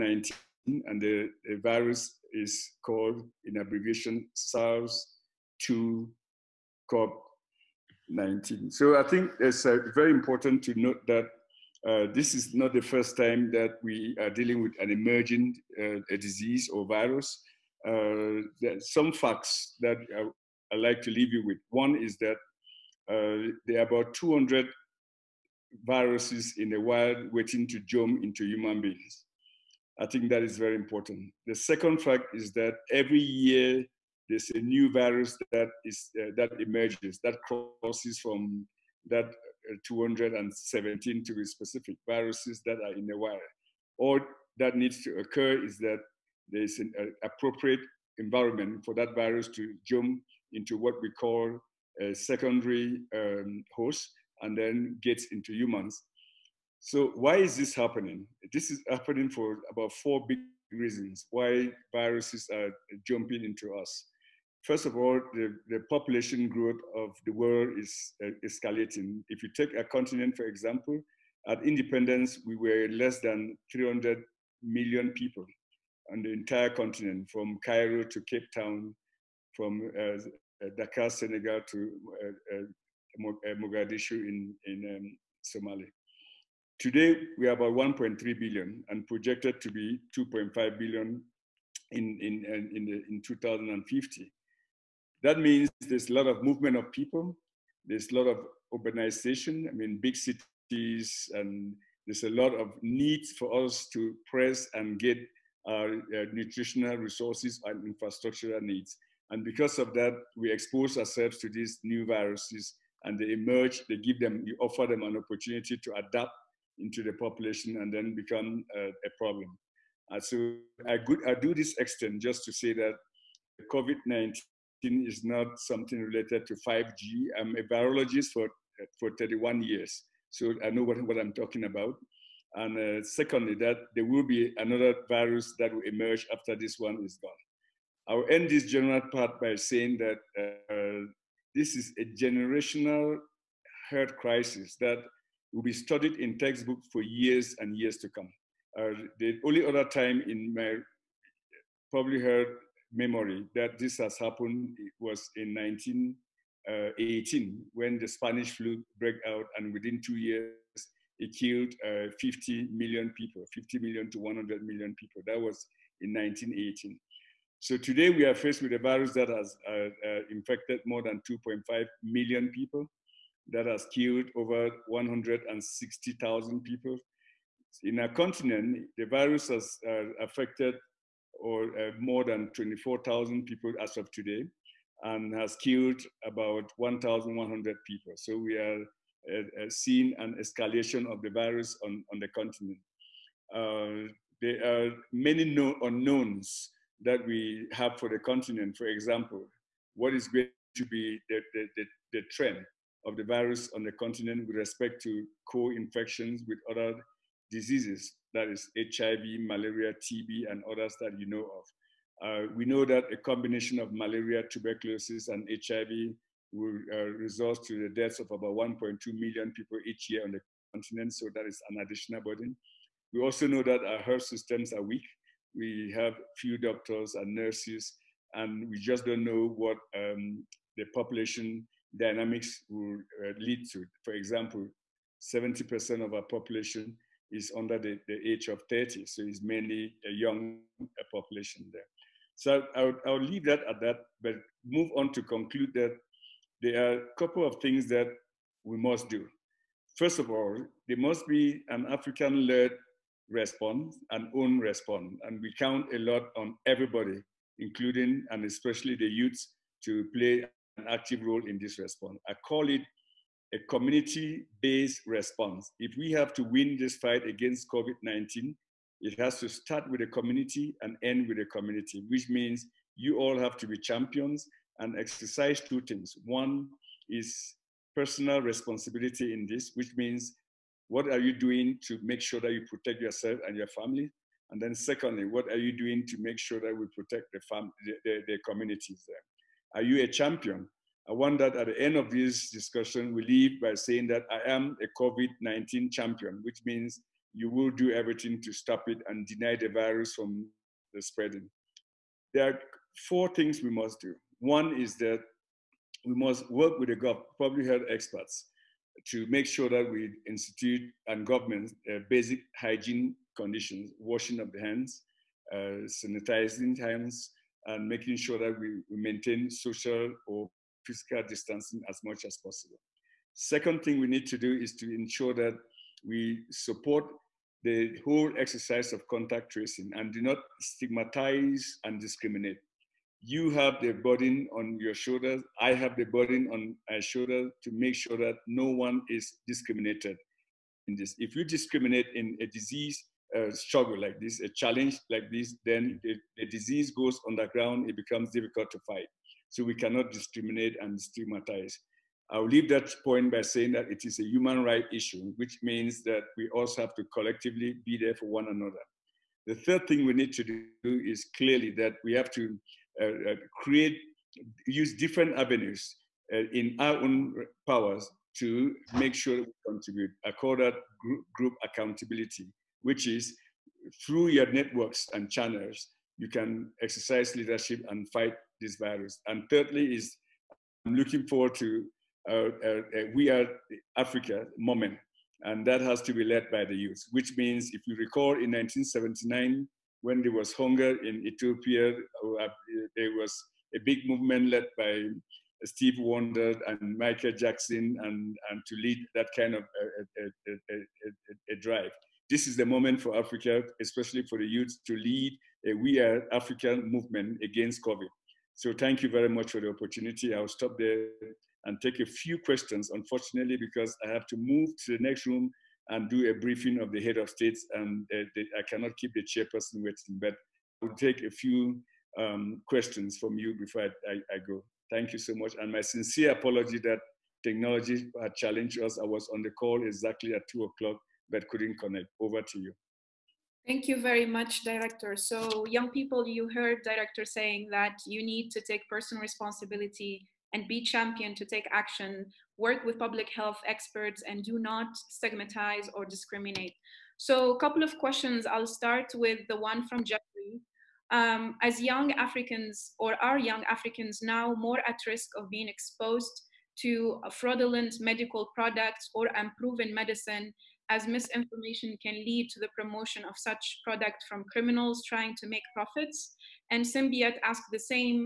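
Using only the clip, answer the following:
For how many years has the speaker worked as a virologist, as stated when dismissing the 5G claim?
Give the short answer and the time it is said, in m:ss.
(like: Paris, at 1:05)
31, at 2:09.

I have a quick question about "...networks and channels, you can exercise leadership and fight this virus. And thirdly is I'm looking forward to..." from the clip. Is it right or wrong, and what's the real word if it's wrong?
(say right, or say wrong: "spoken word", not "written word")
right.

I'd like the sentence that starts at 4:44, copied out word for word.
And then, secondly, what are you doing to make sure that we protect the, fam- the, the, the communities there?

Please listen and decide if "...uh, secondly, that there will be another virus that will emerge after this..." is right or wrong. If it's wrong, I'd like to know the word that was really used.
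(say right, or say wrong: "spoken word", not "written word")
right.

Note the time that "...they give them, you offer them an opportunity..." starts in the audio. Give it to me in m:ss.
1:53.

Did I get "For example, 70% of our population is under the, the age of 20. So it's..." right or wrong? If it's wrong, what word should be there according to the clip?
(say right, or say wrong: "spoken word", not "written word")
wrong: "30", not "20".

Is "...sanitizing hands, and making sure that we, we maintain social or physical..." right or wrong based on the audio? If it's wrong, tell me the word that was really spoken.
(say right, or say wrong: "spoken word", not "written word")
right.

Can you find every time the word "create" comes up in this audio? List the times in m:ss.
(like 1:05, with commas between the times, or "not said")
6:03.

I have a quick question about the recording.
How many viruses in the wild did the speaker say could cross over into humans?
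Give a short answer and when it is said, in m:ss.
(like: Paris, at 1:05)
217, at 0:39.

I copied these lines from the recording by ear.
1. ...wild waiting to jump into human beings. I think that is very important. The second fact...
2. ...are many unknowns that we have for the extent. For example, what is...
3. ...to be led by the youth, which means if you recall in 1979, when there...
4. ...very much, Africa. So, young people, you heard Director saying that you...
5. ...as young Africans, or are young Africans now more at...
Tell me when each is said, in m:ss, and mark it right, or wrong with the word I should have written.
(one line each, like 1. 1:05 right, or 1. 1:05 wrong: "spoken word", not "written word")
1. 0:26 right
2. 3:14 wrong: "continent", not "extent"
3. 6:26 right
4. 7:14 wrong: "Director", not "Africa"
5. 7:31 right.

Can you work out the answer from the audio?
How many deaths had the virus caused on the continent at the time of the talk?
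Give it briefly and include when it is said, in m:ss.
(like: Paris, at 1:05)
about 1,100, at 3:06.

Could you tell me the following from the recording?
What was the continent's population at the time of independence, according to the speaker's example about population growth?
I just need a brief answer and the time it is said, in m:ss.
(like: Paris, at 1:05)
less than 300 million, at 1:12.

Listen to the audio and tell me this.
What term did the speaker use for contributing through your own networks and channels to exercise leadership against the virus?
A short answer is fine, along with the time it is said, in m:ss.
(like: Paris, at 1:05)
group accountability, at 6:11.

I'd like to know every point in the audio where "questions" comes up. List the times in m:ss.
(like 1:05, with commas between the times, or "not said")
6:52, 7:02, 7:27.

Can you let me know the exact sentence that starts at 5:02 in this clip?
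There are four things we must do.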